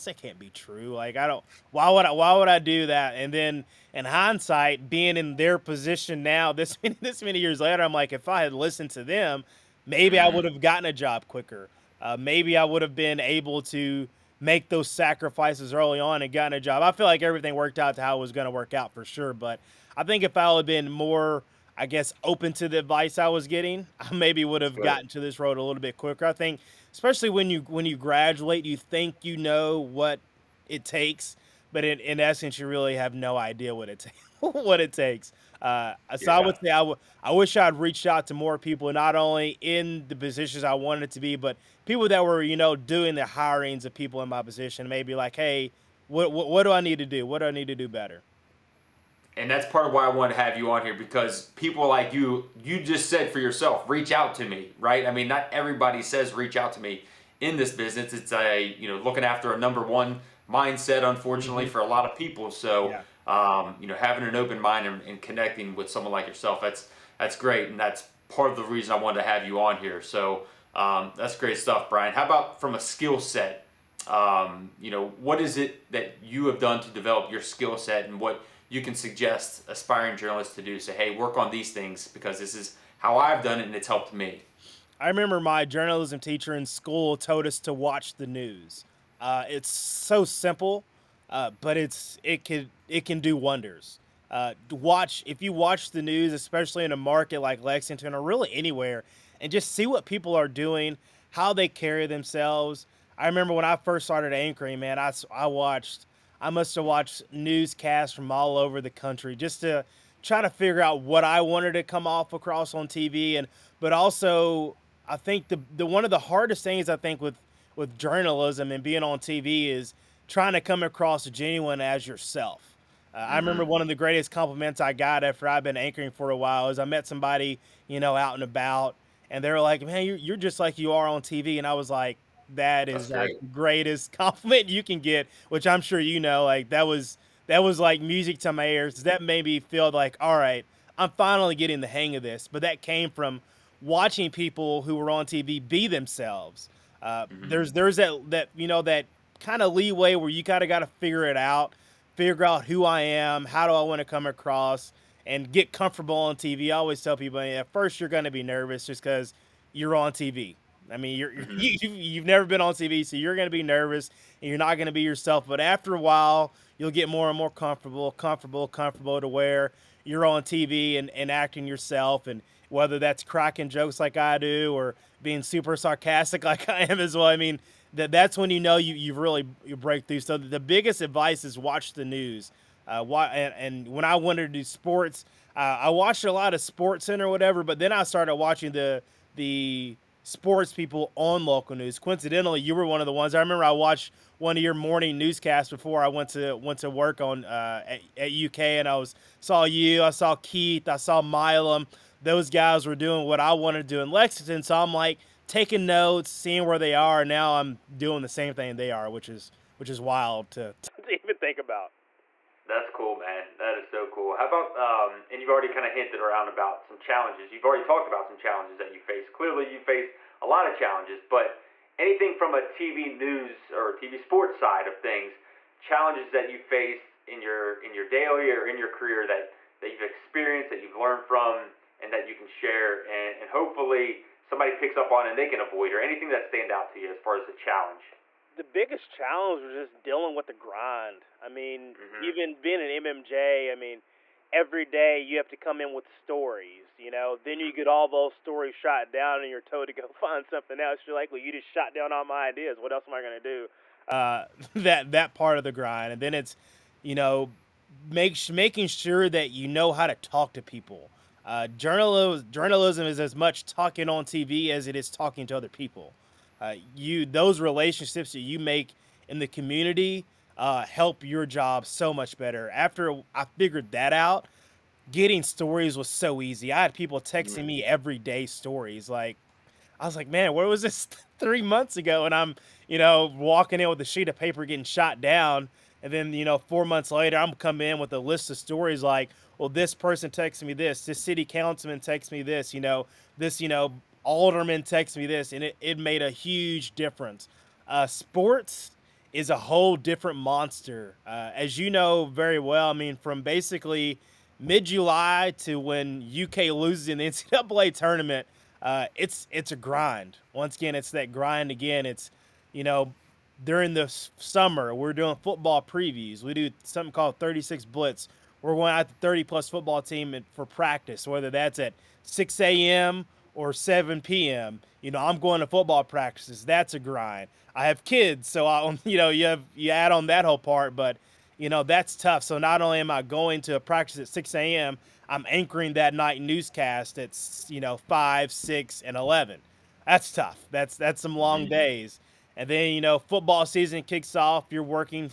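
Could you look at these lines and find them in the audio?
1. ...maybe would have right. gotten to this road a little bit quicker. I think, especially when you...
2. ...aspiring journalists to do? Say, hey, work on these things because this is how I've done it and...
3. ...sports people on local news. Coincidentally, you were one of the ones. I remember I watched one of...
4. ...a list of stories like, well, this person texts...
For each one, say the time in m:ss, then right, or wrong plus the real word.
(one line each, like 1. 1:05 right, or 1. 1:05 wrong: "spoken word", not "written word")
1. 0:24 right
2. 1:19 right
3. 3:10 right
4. 4:48 right.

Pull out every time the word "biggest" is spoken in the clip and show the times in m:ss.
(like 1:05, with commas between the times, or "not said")
3:00, 3:58.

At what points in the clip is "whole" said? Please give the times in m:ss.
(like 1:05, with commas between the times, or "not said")
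4:59, 5:30.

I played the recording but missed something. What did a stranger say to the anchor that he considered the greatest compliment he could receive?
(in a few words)
You're just like you are on TV.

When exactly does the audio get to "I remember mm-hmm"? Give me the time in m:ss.
2:03.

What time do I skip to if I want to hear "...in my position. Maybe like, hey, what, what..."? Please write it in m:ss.
0:44.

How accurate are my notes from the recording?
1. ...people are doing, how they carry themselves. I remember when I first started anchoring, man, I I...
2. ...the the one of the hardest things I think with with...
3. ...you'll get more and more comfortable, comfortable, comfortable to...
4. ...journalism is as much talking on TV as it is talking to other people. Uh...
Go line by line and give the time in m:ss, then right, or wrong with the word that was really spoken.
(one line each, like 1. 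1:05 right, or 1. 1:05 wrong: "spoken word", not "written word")
1. 1:40 right
2. 1:55 right
3. 2:46 right
4. 4:22 right.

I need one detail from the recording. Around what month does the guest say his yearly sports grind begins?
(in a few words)
July.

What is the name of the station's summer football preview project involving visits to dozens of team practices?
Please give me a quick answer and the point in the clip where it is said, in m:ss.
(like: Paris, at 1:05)
36 Blitz, at 5:17.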